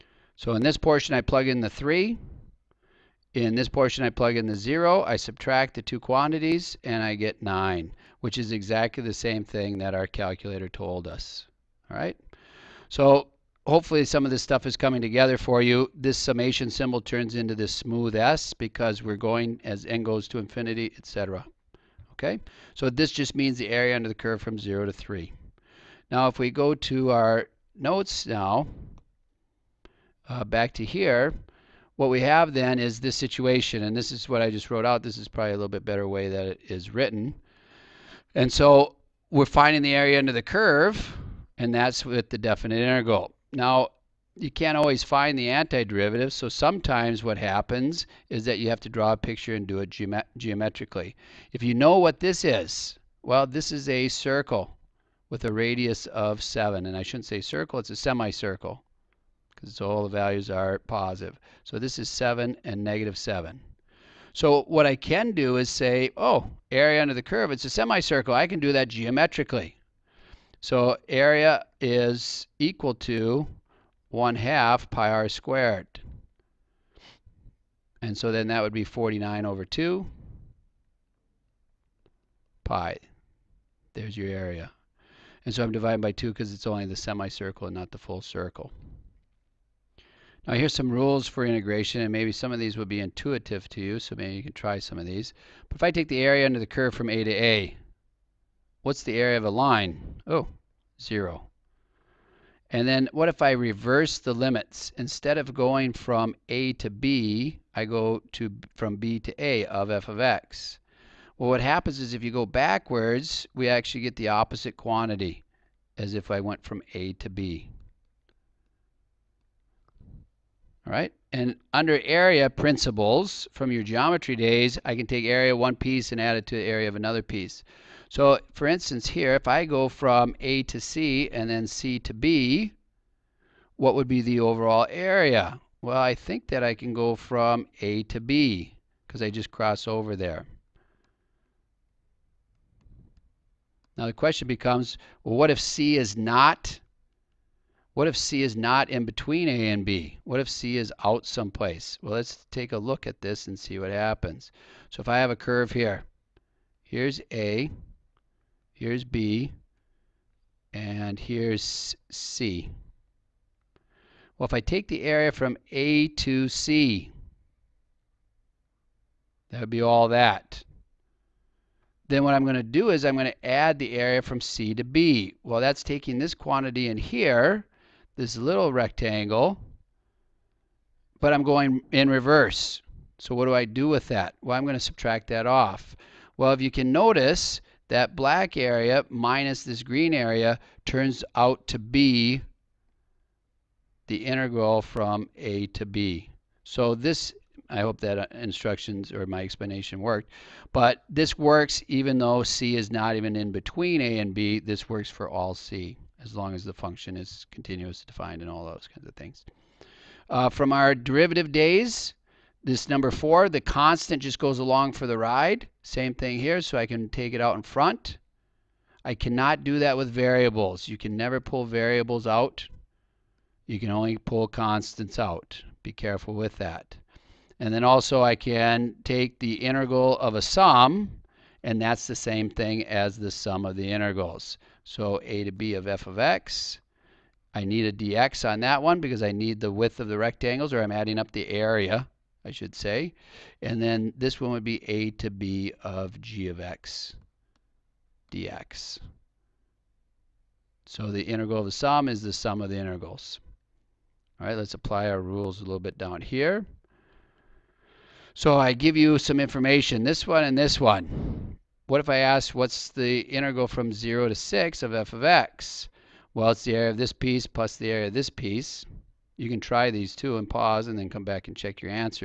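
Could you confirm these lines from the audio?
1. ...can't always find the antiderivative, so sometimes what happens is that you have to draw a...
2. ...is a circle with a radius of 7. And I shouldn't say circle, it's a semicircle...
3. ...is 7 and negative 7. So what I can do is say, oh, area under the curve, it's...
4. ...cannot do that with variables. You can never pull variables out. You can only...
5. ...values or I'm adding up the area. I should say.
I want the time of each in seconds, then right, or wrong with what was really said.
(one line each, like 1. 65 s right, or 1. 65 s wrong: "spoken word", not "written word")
1. 44 s right
2. 53 s right
3. 61 s right
4. 219 s right
5. 240 s wrong: "rectangles", not "values".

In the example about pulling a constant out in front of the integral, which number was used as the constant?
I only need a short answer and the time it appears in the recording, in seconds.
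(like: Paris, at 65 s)
4, at 213 s.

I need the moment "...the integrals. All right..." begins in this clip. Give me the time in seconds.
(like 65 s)
252 s.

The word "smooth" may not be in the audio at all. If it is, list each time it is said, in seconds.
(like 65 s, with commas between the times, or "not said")
17 s.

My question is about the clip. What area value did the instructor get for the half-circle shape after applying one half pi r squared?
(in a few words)
49/2 pi.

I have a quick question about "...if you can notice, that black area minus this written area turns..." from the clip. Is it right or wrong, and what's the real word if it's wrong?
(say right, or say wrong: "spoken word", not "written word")
wrong: "green", not "written".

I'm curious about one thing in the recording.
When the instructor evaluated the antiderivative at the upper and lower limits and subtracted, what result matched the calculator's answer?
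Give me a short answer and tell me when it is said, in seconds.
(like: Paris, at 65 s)
9, at 7 s.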